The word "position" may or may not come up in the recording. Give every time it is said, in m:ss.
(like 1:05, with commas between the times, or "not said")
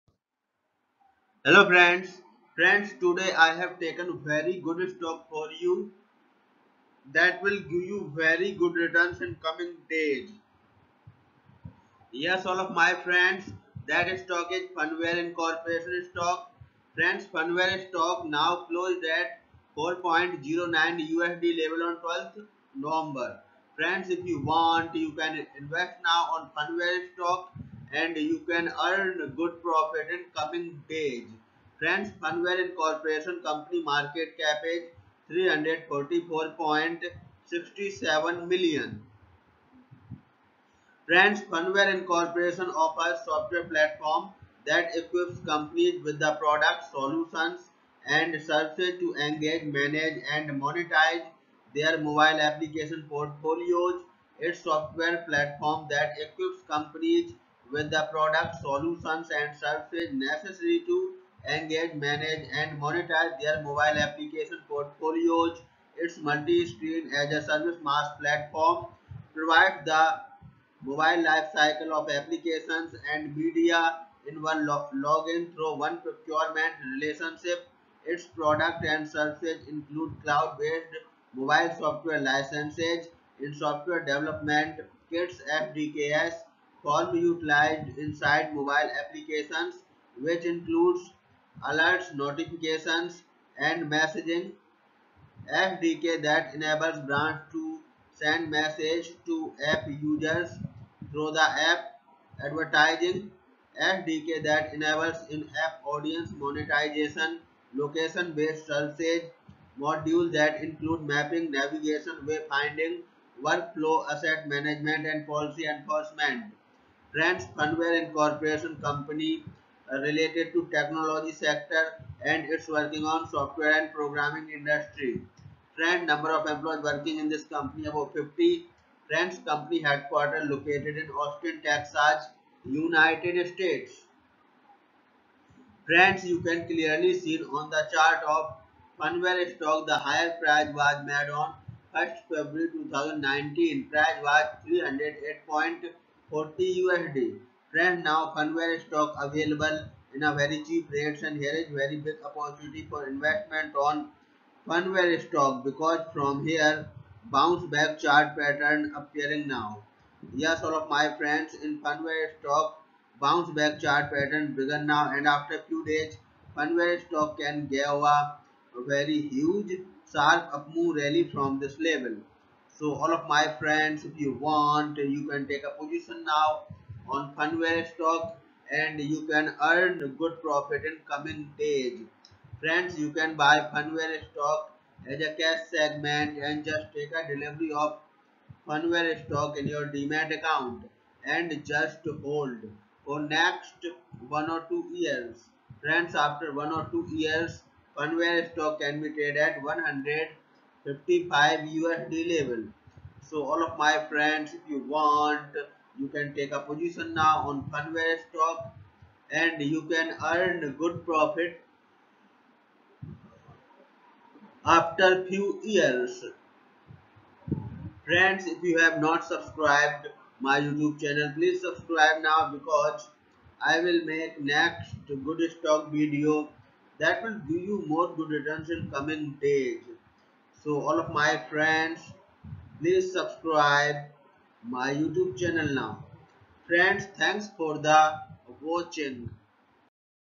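2:55, 3:26.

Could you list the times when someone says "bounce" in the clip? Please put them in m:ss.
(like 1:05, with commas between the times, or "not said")
2:37, 2:43.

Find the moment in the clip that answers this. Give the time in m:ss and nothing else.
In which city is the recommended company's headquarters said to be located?
2:11.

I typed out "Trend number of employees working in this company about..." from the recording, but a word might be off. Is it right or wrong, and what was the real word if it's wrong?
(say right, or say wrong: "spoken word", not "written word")
right.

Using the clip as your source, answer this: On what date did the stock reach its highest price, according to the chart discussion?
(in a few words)
1st February 2019.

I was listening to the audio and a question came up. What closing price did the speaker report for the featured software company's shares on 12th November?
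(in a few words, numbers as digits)
4.09 USD.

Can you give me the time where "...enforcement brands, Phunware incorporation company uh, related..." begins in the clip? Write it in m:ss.
1:55.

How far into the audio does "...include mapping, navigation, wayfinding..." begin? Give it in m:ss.
1:50.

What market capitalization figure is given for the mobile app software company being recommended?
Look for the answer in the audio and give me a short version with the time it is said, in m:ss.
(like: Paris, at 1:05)
344.67 million, at 0:35.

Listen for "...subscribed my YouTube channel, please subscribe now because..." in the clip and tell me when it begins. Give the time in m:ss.
3:39.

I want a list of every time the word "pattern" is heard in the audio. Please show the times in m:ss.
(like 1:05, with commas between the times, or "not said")
2:38, 2:44.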